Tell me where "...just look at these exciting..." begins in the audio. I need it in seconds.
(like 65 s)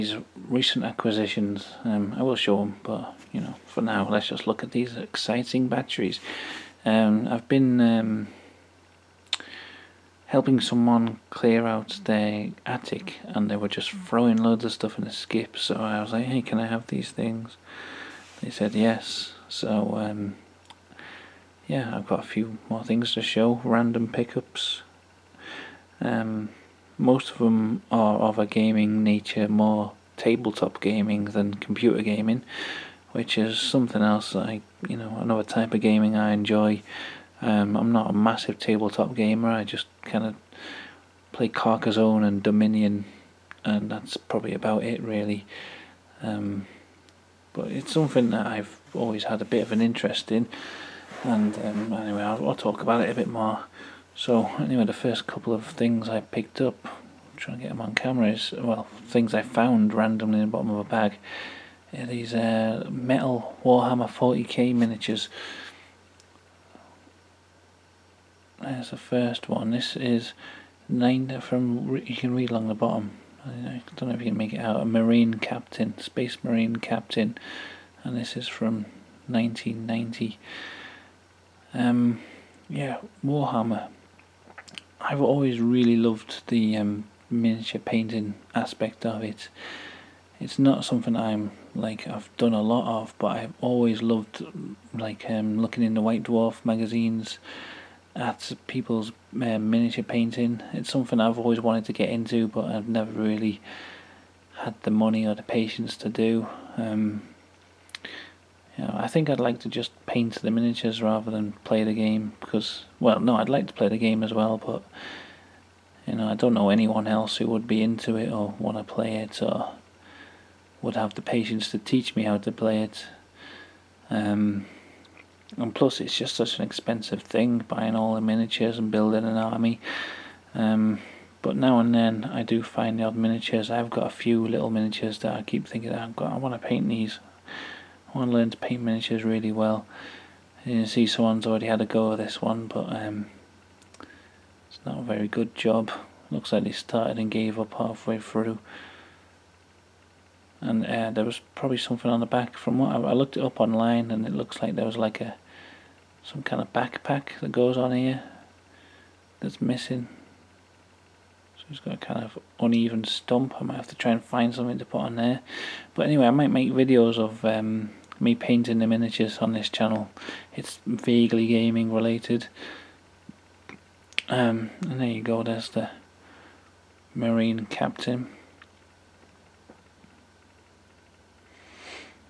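4 s.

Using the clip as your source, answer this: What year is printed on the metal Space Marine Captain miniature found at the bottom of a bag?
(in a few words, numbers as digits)
1990.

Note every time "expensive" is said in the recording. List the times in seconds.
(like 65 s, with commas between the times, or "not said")
126 s.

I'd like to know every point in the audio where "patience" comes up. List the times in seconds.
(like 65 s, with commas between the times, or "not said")
105 s, 121 s.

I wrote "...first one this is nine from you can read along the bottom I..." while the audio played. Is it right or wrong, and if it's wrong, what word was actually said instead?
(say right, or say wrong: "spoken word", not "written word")
right.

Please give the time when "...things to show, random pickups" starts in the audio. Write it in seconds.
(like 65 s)
22 s.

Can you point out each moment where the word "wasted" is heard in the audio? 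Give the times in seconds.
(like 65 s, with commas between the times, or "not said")
not said.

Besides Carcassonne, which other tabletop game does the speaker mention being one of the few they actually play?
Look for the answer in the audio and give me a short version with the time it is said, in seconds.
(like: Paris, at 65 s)
Dominion, at 42 s.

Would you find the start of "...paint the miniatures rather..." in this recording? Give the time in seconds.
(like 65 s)
110 s.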